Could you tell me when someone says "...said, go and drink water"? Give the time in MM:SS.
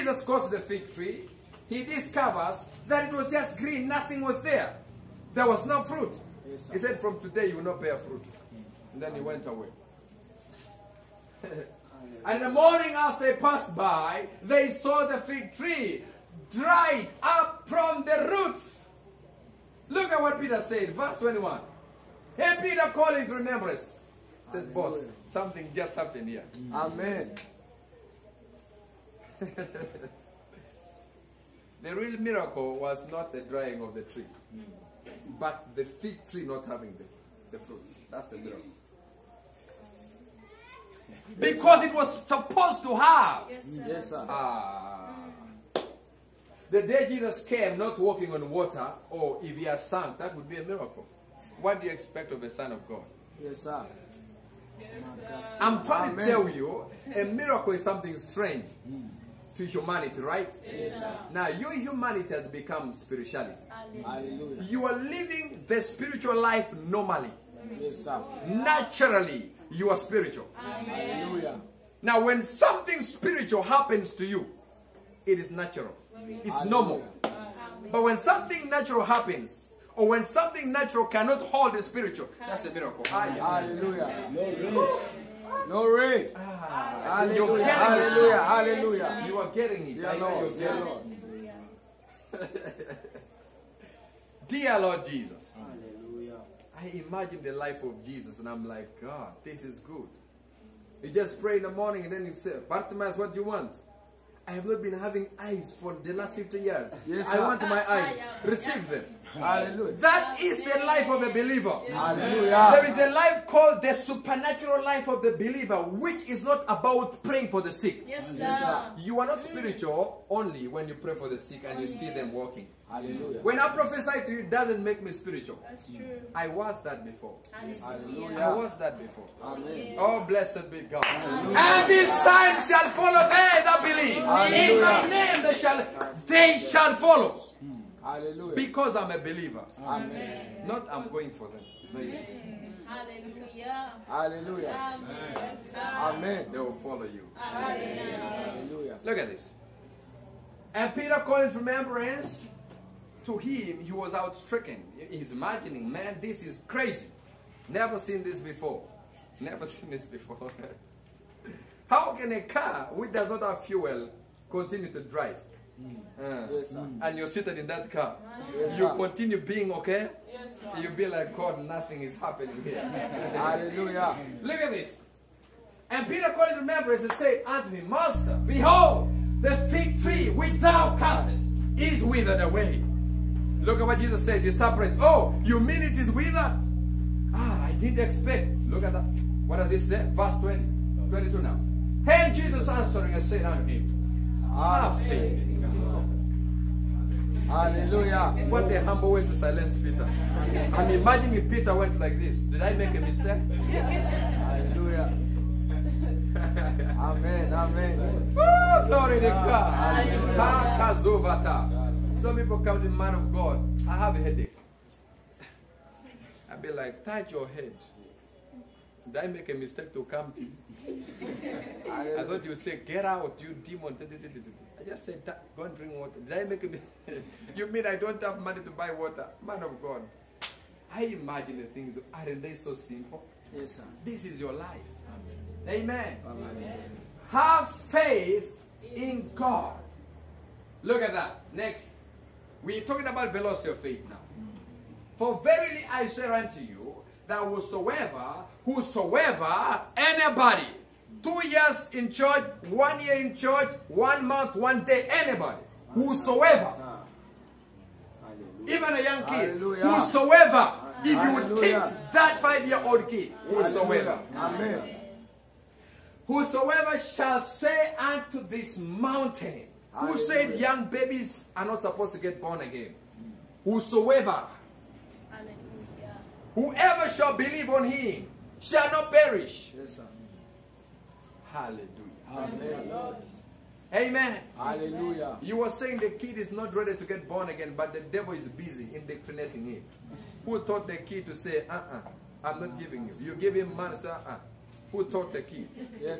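03:45.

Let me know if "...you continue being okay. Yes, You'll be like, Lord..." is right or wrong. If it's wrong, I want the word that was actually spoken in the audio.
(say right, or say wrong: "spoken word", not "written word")
wrong: "God", not "Lord".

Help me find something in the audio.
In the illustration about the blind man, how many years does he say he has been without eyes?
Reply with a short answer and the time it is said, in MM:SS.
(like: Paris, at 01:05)
50, at 01:46.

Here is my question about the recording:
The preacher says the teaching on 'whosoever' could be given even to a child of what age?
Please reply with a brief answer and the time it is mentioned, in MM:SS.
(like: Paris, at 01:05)
5, at 04:22.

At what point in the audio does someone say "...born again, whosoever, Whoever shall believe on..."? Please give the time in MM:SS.
04:32.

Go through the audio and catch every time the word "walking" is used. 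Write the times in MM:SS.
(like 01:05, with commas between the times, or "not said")
00:47, 02:02.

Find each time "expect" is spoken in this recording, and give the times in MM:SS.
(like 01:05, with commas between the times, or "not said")
00:51, 03:07.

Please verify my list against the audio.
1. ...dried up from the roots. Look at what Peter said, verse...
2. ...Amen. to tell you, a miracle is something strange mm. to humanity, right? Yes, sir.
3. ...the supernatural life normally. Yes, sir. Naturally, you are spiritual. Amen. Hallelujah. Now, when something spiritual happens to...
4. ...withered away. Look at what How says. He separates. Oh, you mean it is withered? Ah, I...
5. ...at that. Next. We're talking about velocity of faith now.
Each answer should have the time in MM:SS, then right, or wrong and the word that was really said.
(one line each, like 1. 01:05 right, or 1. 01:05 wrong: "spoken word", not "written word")
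1. 00:16 right
2. 00:56 right
3. 01:05 wrong: "spiritual", not "supernatural"
4. 03:02 wrong: "Jesus", not "How"
5. 04:01 right.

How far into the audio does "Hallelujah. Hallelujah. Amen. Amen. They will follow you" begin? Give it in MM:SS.
02:22.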